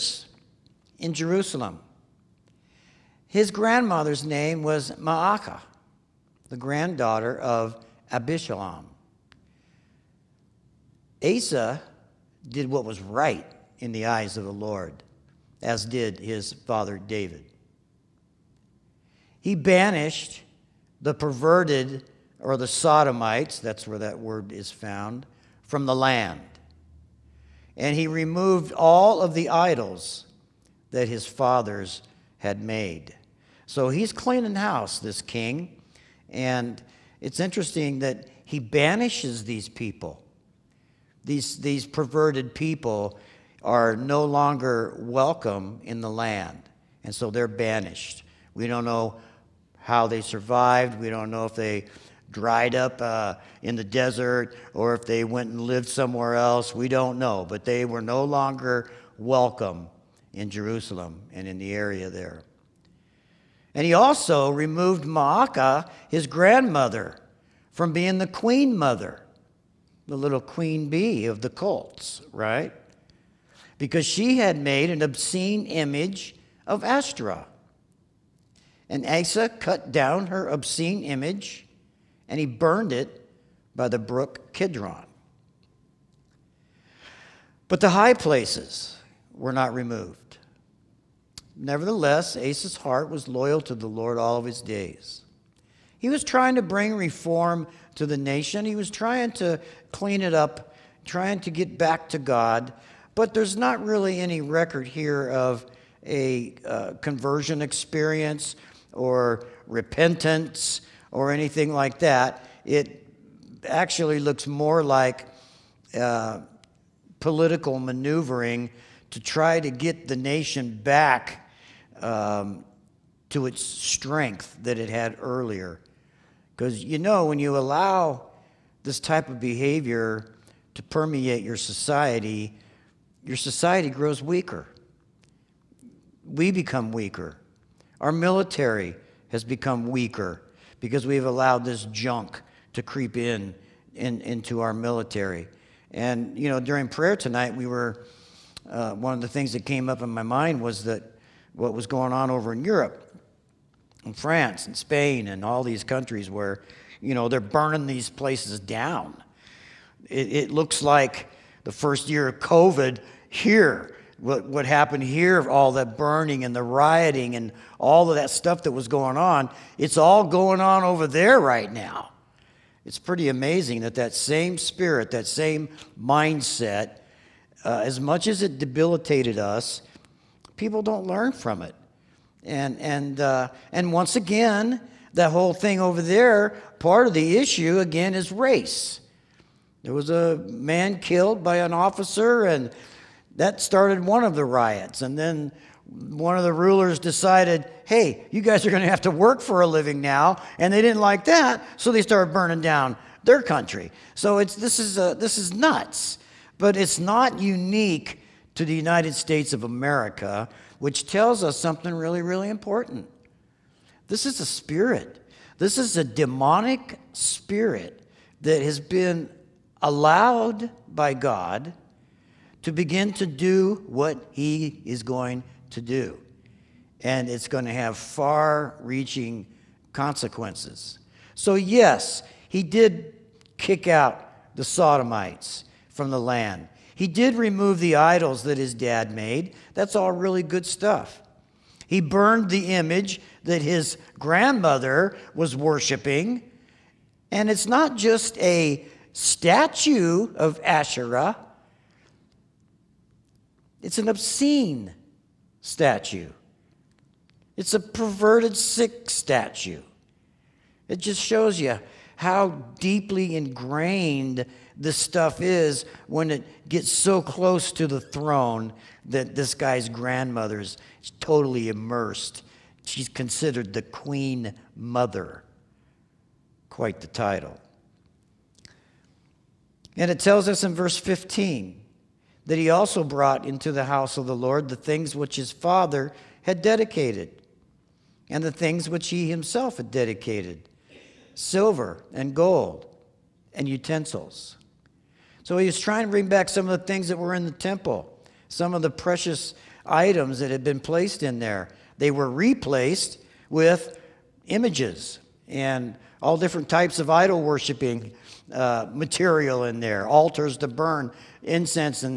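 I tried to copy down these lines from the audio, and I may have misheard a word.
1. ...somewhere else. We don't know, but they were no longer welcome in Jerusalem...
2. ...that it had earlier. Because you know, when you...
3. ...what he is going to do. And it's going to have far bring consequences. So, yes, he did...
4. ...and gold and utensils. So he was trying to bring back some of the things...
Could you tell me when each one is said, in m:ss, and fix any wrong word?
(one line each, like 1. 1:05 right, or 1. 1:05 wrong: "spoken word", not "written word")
1. 0:55 right
2. 2:04 right
3. 3:43 wrong: "reaching", not "bring"
4. 4:52 right.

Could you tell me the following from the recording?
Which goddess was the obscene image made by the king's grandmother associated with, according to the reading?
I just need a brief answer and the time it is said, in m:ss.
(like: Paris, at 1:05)
Ashtaroth, at 1:16.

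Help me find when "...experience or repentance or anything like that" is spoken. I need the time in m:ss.
1:47.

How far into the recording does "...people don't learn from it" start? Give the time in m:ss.
3:00.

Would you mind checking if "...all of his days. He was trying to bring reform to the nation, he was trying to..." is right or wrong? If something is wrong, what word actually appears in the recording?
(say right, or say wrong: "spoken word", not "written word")
right.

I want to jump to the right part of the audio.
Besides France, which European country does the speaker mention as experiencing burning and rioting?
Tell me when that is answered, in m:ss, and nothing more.
2:34.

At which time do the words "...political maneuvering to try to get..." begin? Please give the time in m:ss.
1:57.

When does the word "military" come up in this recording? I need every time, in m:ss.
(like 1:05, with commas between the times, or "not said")
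2:18, 2:24.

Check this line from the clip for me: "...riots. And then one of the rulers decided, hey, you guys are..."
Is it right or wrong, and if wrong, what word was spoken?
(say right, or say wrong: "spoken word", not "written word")
right.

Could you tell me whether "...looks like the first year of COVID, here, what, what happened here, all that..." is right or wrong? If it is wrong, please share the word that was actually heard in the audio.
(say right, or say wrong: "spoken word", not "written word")
right.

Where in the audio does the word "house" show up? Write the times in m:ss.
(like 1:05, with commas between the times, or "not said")
0:34, 4:43.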